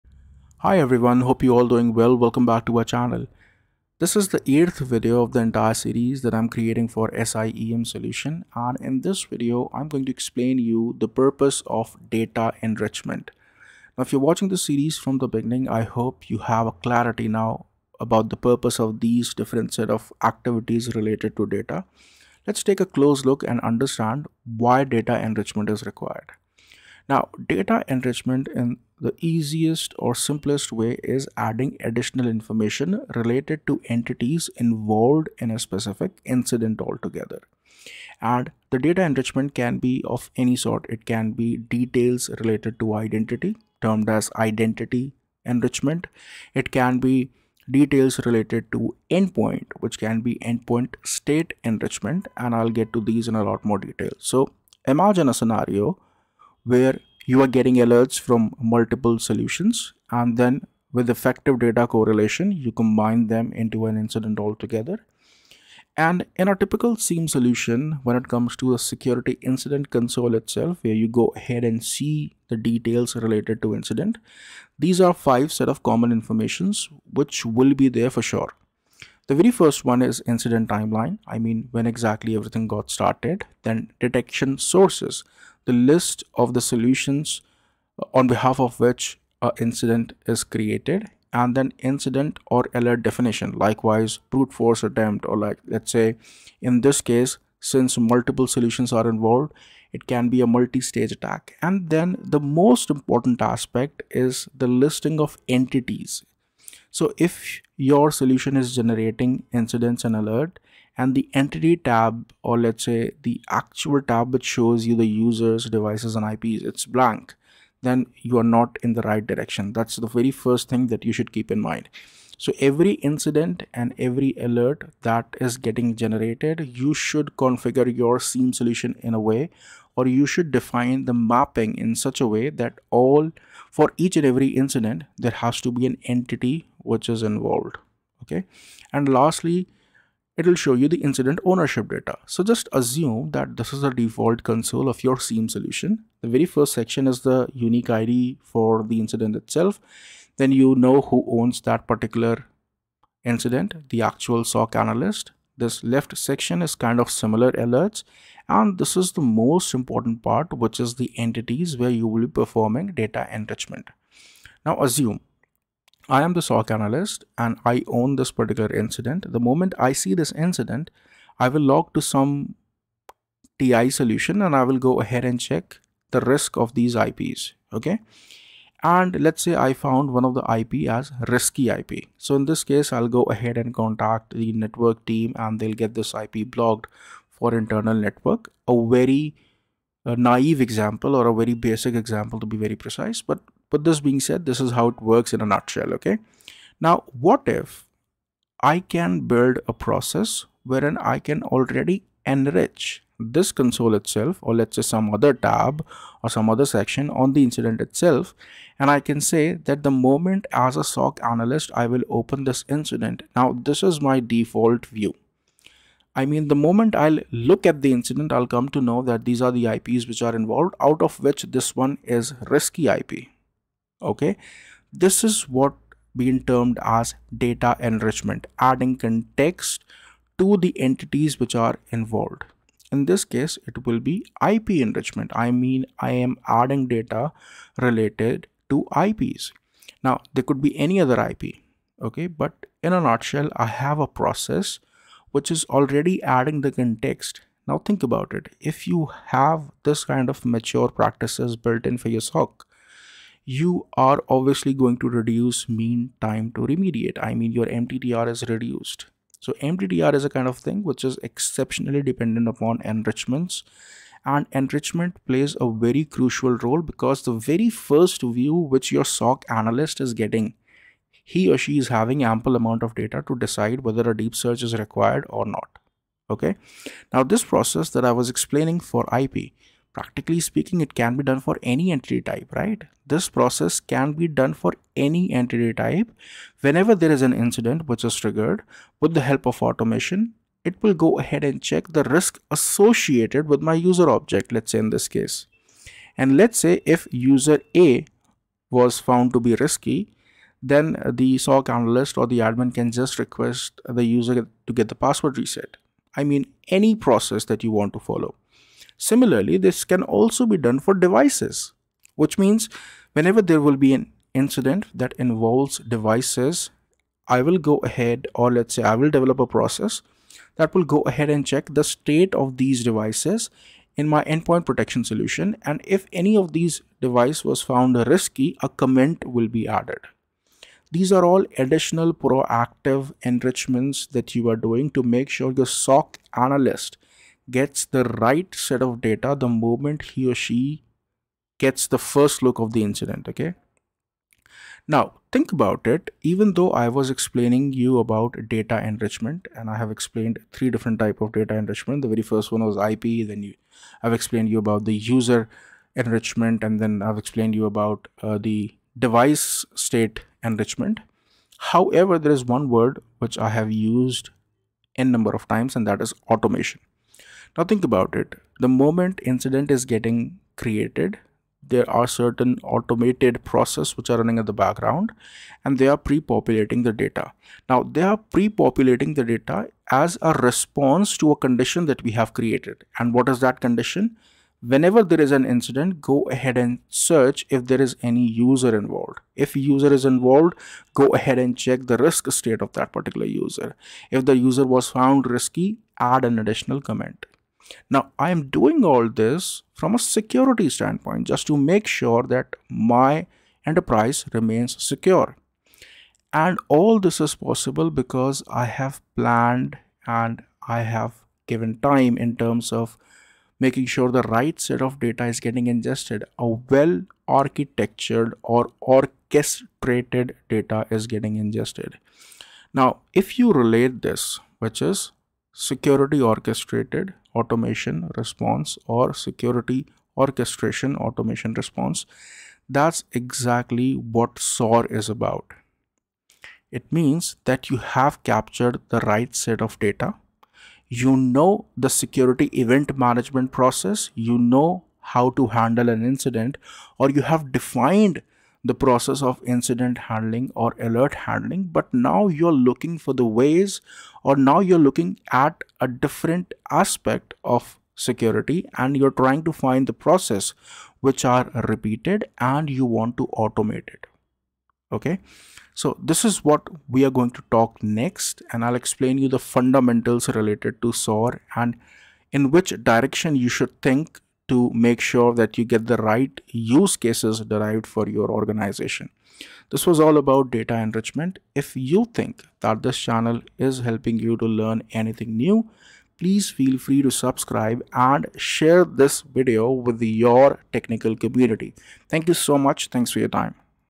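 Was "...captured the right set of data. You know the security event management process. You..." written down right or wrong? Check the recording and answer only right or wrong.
right.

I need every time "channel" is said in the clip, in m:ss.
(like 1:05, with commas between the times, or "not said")
0:02, 8:02.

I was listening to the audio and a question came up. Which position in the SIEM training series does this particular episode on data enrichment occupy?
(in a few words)
8th.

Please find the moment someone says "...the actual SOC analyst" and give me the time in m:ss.
2:33.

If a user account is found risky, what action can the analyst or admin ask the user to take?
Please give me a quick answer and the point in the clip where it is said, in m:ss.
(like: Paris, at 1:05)
password reset, at 5:04.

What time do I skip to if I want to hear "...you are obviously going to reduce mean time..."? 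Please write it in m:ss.
4:13.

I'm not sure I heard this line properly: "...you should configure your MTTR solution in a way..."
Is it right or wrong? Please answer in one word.
wrong.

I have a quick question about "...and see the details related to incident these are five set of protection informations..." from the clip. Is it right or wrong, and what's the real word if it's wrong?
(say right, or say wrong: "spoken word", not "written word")
wrong: "common", not "protection".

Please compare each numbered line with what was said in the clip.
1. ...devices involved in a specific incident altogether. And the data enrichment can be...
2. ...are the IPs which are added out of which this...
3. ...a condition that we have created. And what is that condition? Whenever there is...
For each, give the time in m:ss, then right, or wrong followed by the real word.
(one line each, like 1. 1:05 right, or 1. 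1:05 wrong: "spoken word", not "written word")
1. 0:33 wrong: "entities", not "devices"
2. 3:39 wrong: "involved", not "added"
3. 6:21 right.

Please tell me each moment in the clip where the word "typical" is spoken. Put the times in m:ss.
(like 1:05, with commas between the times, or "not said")
1:06.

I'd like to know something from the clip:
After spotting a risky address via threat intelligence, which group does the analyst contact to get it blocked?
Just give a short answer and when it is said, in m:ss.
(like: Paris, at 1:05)
network team, at 3:04.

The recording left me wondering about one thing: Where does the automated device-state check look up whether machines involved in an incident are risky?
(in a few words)
endpoint protection solution.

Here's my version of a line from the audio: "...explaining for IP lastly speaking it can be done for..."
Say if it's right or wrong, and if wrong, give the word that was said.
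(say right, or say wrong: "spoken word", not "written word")
wrong: "practically", not "lastly".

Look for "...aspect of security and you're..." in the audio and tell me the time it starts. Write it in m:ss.
7:36.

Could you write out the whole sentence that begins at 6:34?
If the user was found risky, add an additional comment.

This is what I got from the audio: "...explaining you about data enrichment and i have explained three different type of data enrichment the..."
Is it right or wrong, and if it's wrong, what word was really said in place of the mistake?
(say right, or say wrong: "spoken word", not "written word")
right.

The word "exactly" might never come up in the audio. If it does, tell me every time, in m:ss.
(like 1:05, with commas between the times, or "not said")
1:21, 7:13.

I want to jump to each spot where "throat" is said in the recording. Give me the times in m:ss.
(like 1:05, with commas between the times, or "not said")
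not said.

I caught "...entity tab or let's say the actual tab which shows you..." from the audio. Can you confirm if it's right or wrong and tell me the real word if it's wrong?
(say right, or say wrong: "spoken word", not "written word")
right.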